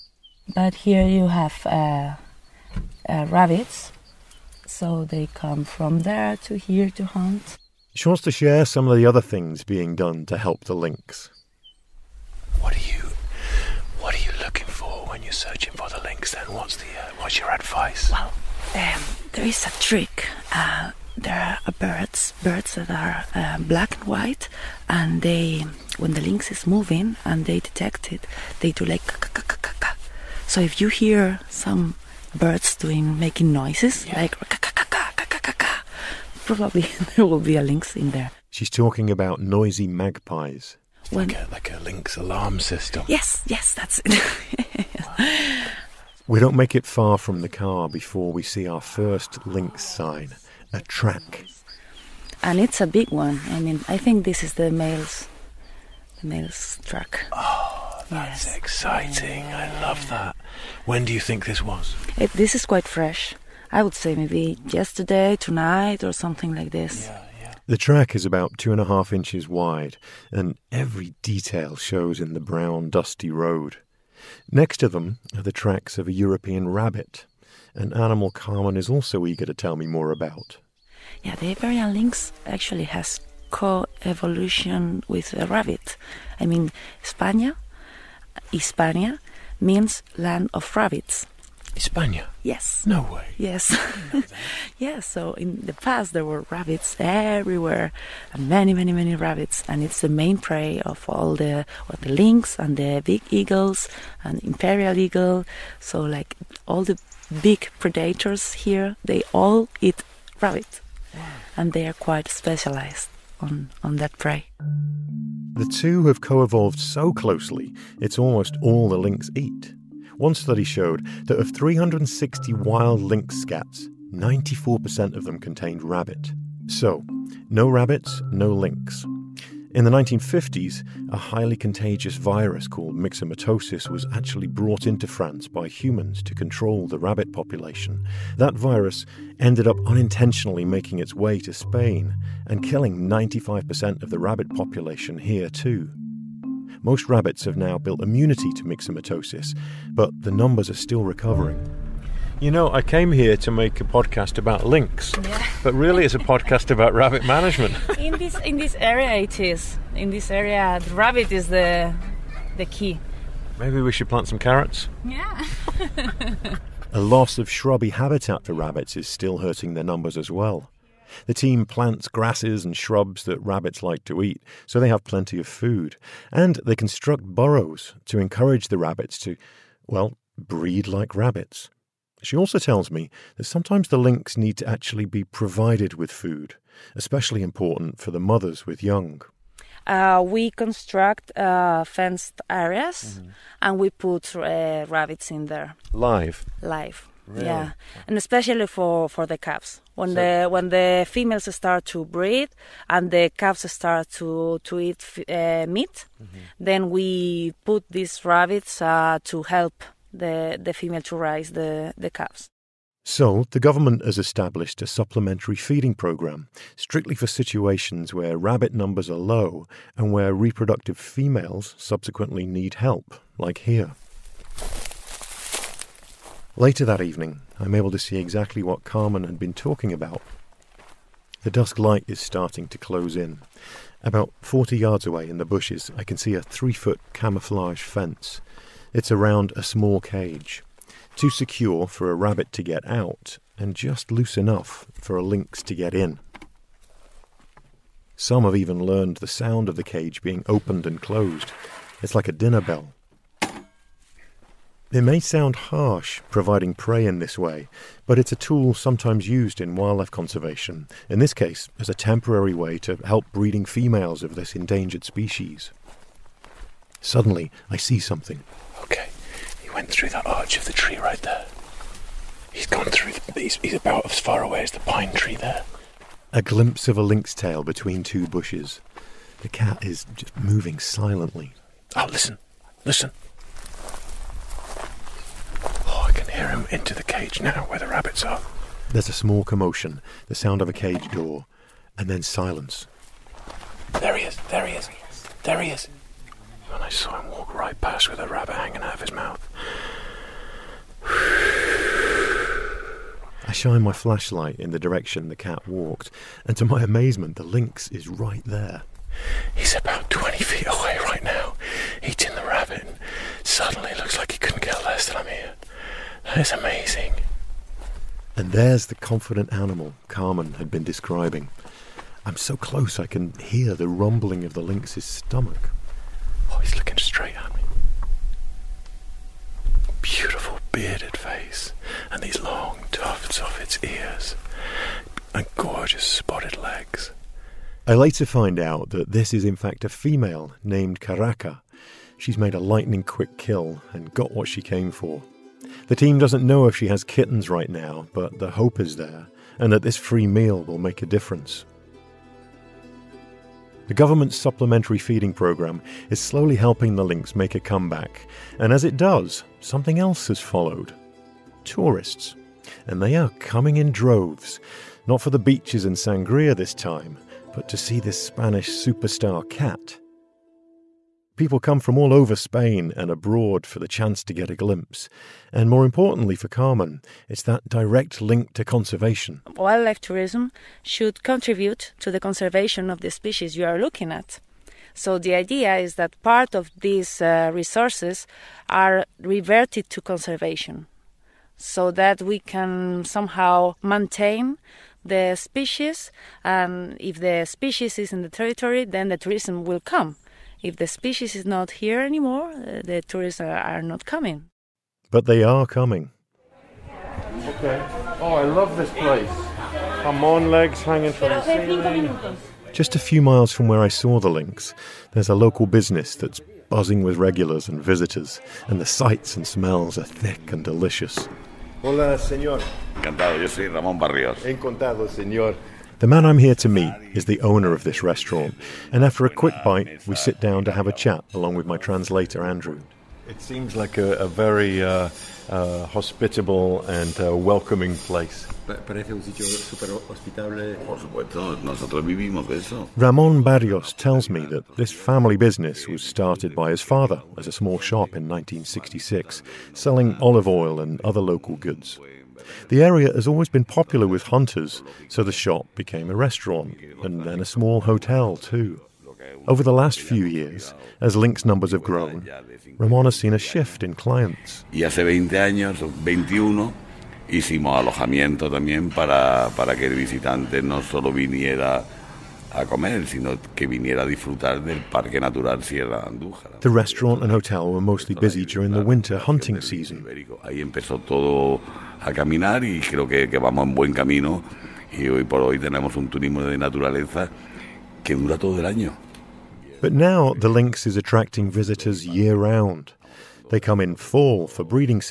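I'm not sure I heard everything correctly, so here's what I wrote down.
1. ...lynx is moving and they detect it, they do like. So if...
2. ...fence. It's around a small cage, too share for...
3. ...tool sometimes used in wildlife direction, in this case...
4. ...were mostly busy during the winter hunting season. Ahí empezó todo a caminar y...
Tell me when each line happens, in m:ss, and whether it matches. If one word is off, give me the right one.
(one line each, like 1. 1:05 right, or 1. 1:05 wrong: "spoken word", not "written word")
1. 0:26 right
2. 3:57 wrong: "secure", not "share"
3. 4:18 wrong: "conservation", not "direction"
4. 7:57 right.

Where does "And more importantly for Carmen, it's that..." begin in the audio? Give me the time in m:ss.
6:15.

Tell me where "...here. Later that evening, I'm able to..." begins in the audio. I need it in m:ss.
3:43.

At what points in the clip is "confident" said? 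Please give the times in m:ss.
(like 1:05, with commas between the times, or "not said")
5:18.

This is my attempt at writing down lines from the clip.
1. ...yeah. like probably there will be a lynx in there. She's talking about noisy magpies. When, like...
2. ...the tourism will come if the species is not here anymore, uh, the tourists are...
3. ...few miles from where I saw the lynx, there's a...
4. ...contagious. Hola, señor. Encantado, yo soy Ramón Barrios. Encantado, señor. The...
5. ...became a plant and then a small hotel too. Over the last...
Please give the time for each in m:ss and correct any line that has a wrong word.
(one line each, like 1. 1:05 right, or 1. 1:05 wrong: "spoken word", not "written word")
1. 0:34 right
2. 6:39 right
3. 6:52 right
4. 7:00 wrong: "delicious", not "contagious"
5. 7:35 wrong: "restaurant", not "plant".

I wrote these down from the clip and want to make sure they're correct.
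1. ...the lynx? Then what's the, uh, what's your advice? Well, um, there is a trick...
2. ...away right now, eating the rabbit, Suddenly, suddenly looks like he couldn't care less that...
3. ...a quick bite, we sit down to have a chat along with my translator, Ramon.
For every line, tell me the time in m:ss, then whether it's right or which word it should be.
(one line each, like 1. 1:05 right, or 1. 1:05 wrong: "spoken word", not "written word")
1. 0:15 right
2. 5:10 right
3. 7:09 wrong: "Andrew", not "Ramon".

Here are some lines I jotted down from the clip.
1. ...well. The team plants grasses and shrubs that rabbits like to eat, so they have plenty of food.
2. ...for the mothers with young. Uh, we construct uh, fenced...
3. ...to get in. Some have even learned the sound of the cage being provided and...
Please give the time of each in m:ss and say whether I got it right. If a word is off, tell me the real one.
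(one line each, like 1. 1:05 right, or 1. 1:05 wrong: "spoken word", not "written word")
1. 2:50 right
2. 3:07 right
3. 4:05 wrong: "opened", not "provided".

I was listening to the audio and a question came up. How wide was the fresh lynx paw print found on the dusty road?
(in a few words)
2.5 inches.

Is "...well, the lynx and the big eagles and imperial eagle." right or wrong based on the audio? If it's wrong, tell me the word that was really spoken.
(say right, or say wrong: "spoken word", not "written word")
right.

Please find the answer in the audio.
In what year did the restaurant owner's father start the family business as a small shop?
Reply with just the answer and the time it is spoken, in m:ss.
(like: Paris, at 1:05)
1966, at 7:28.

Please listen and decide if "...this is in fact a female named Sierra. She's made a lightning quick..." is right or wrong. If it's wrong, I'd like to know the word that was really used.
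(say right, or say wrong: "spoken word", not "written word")
wrong: "Caraca", not "Sierra".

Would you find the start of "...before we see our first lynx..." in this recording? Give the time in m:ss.
0:47.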